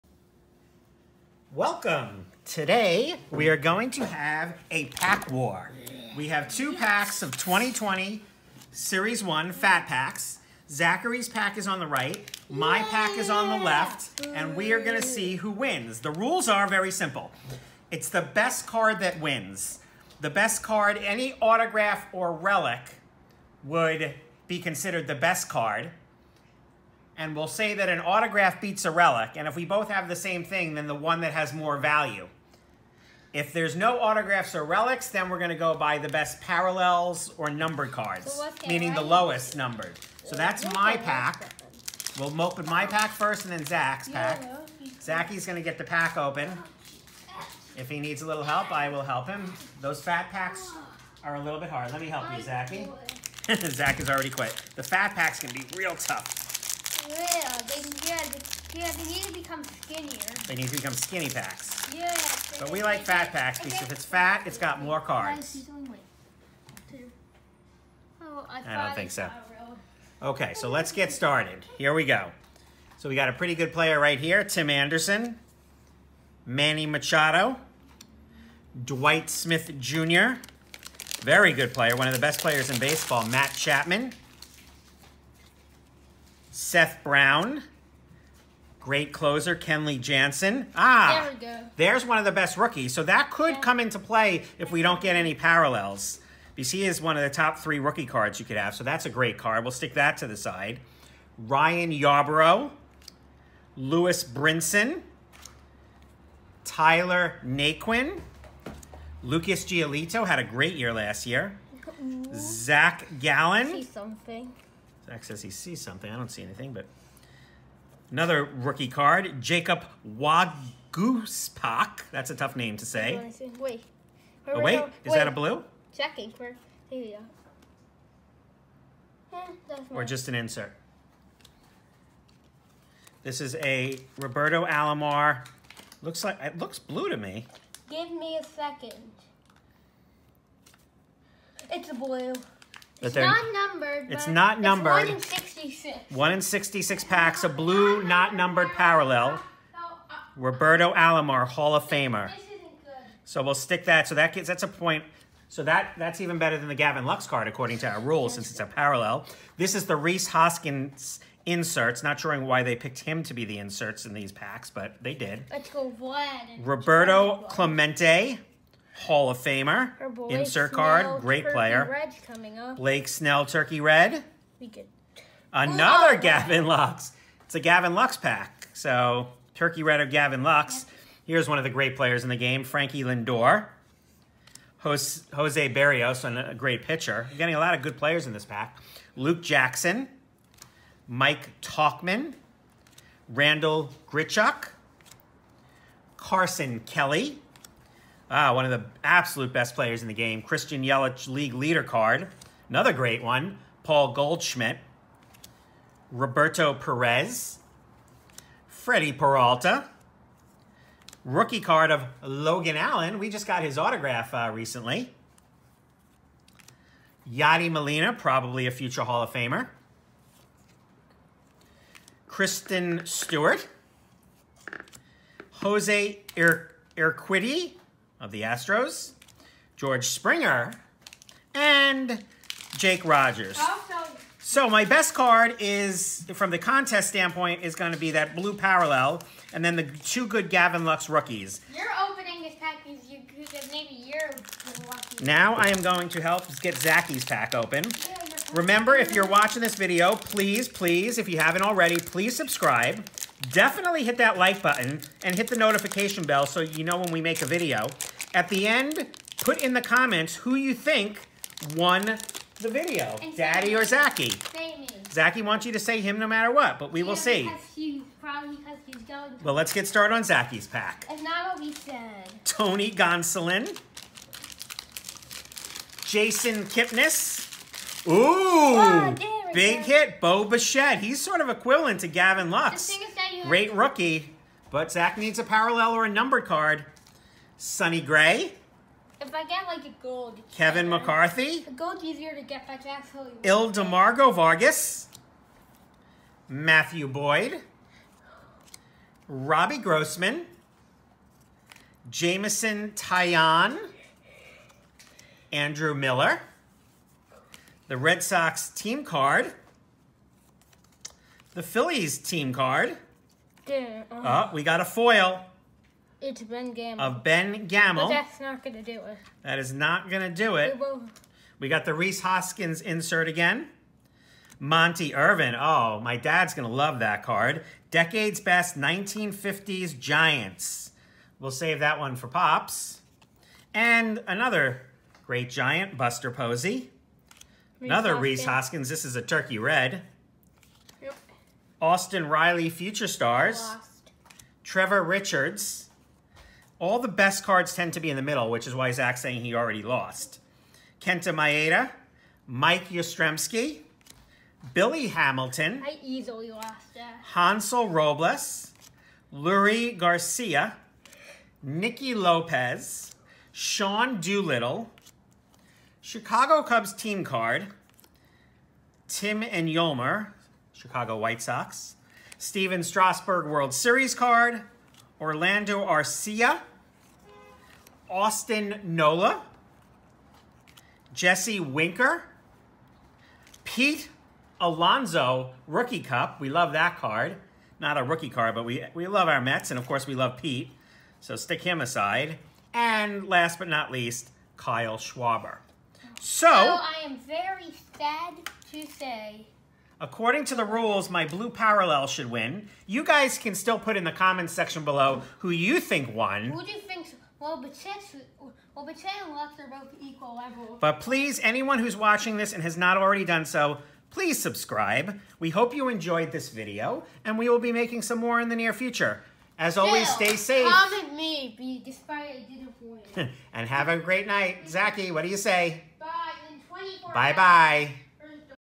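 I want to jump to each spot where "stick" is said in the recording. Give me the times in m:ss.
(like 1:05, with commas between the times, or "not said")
1:39, 2:33, 6:31.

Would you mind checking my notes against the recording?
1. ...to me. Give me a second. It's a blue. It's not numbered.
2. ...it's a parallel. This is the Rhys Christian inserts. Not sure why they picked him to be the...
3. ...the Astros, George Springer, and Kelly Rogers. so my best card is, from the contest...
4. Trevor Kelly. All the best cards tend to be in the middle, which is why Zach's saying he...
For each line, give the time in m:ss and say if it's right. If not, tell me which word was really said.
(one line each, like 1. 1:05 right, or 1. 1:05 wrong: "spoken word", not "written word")
1. 2:17 right
2. 2:38 wrong: "Hoskins", not "Christian"
3. 3:48 wrong: "Jake", not "Kelly"
4. 5:44 wrong: "Richards", not "Kelly".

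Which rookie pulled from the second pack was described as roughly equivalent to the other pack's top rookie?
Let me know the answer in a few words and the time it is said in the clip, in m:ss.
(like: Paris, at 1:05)
Bo Bichette, at 4:40.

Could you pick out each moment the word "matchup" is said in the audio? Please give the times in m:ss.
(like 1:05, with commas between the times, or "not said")
not said.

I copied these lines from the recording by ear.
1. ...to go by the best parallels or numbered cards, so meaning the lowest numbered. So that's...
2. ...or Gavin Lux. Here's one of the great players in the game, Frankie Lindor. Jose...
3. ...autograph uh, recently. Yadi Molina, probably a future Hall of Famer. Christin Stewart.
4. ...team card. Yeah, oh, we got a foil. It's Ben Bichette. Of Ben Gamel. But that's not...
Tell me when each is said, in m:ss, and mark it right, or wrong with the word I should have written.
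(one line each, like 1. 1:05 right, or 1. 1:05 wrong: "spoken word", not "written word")
1. 0:35 right
2. 3:00 right
3. 3:33 right
4. 5:12 wrong: "Gamel", not "Bichette".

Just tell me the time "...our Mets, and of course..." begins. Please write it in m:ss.
6:29.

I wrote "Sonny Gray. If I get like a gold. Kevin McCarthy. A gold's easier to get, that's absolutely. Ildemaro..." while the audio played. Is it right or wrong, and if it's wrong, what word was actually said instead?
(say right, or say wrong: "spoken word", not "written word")
right.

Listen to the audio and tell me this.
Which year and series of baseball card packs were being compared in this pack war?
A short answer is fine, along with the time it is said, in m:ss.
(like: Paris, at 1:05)
2020 Series 1 Fat Packs, at 0:07.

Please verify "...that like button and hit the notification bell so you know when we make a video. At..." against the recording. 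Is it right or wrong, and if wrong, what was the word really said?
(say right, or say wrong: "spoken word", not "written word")
right.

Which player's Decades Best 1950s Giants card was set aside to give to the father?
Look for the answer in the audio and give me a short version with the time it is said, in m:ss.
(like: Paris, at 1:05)
Monte Irvin, at 5:24.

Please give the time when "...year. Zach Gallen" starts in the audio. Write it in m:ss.
1:51.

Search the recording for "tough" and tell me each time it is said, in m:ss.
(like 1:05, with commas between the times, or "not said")
0:55, 2:02.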